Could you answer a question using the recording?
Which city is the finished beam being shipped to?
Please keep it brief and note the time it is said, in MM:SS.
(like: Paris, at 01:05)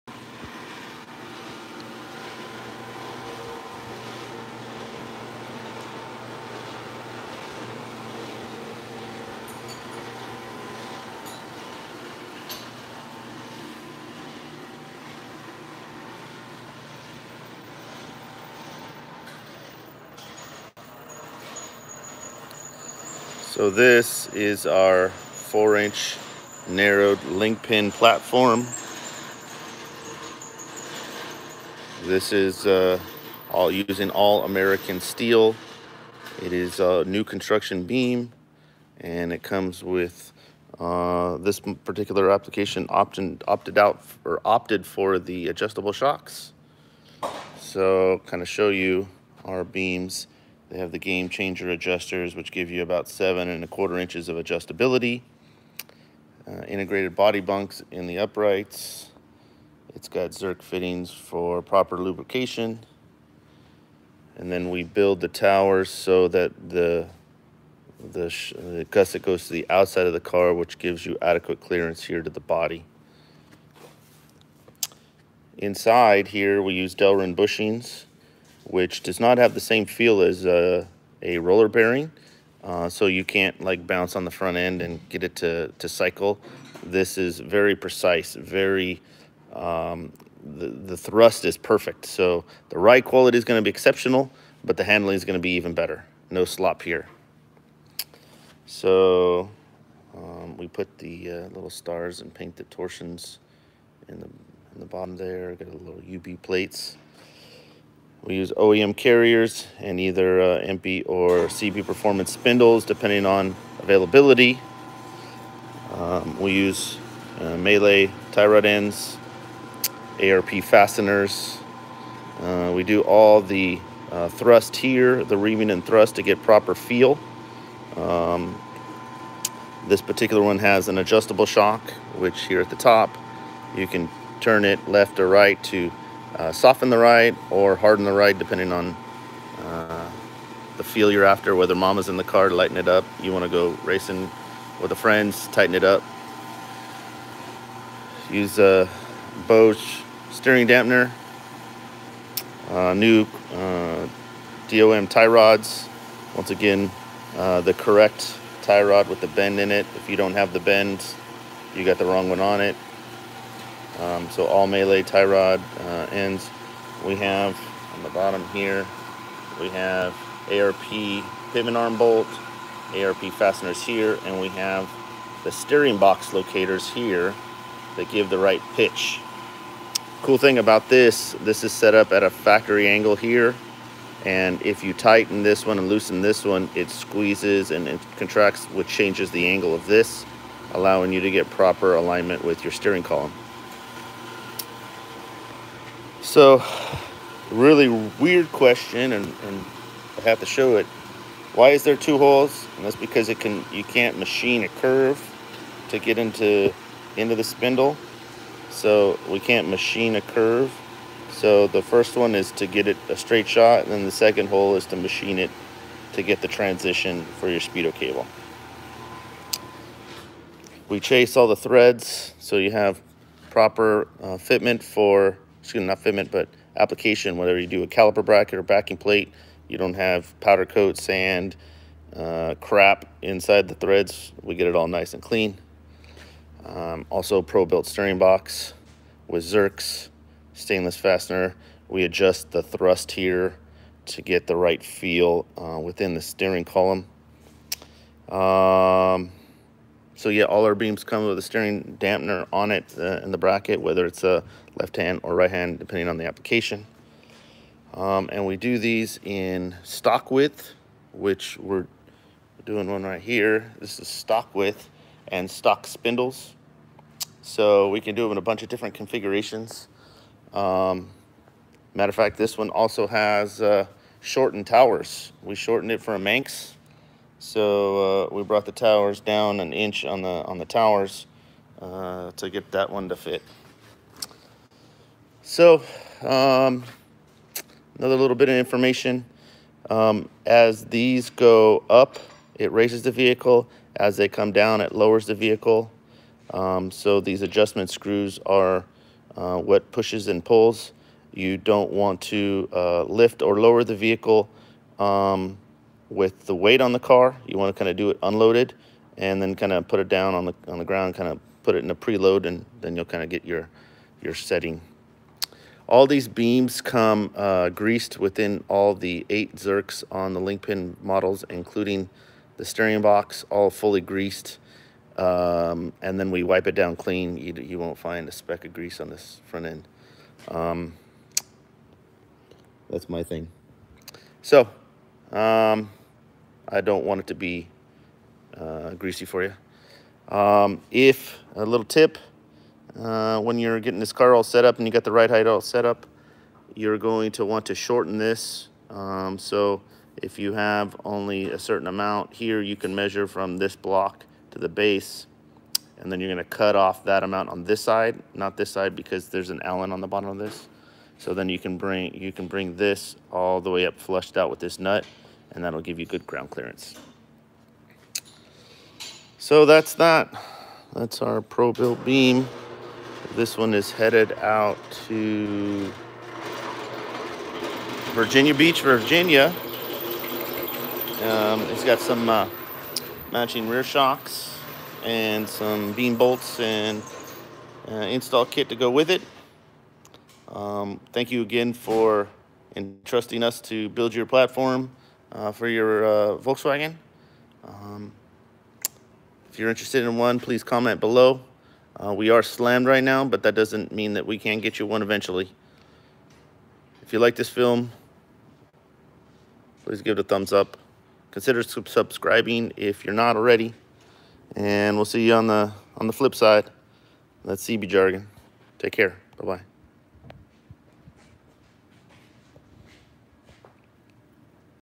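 Virginia Beach, at 06:18.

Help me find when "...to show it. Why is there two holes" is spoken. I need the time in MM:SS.
03:20.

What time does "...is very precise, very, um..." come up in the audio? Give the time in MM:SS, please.
01:27.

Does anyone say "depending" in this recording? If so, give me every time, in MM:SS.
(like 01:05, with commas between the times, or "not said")
01:52, 02:18, 04:15.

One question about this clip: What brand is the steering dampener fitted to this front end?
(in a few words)
Bosch.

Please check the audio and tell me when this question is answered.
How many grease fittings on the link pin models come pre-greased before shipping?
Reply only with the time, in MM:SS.
05:19.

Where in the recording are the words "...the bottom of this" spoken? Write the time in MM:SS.
06:00.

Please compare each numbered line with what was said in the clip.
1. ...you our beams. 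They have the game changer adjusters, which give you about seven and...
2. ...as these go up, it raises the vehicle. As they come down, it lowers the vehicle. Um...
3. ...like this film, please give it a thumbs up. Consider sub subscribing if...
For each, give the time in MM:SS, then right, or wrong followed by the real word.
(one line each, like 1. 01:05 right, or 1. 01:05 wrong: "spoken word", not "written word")
1. 00:48 right
2. 04:50 right
3. 06:47 right.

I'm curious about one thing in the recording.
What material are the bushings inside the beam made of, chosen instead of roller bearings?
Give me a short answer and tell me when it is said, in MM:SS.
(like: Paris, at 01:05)
Delrin, at 01:16.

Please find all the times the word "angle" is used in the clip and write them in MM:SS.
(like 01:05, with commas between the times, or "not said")
03:02, 03:09.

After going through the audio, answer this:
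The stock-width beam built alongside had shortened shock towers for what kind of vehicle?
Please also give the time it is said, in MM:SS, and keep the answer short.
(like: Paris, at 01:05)
Manx, at 04:36.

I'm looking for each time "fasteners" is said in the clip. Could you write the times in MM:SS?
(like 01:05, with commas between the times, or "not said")
02:00, 02:53, 04:00.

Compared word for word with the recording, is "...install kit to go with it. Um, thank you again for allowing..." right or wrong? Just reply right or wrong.
wrong.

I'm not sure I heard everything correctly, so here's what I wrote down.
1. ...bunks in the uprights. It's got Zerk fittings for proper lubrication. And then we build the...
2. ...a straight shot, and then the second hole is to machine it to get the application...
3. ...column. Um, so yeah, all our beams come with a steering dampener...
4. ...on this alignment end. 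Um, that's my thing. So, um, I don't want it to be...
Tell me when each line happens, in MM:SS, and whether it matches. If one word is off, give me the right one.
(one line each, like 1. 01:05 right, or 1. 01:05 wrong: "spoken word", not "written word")
1. 00:57 right
2. 03:33 wrong: "transition", not "application"
3. 04:06 right
4. 05:28 wrong: "front", not "alignment".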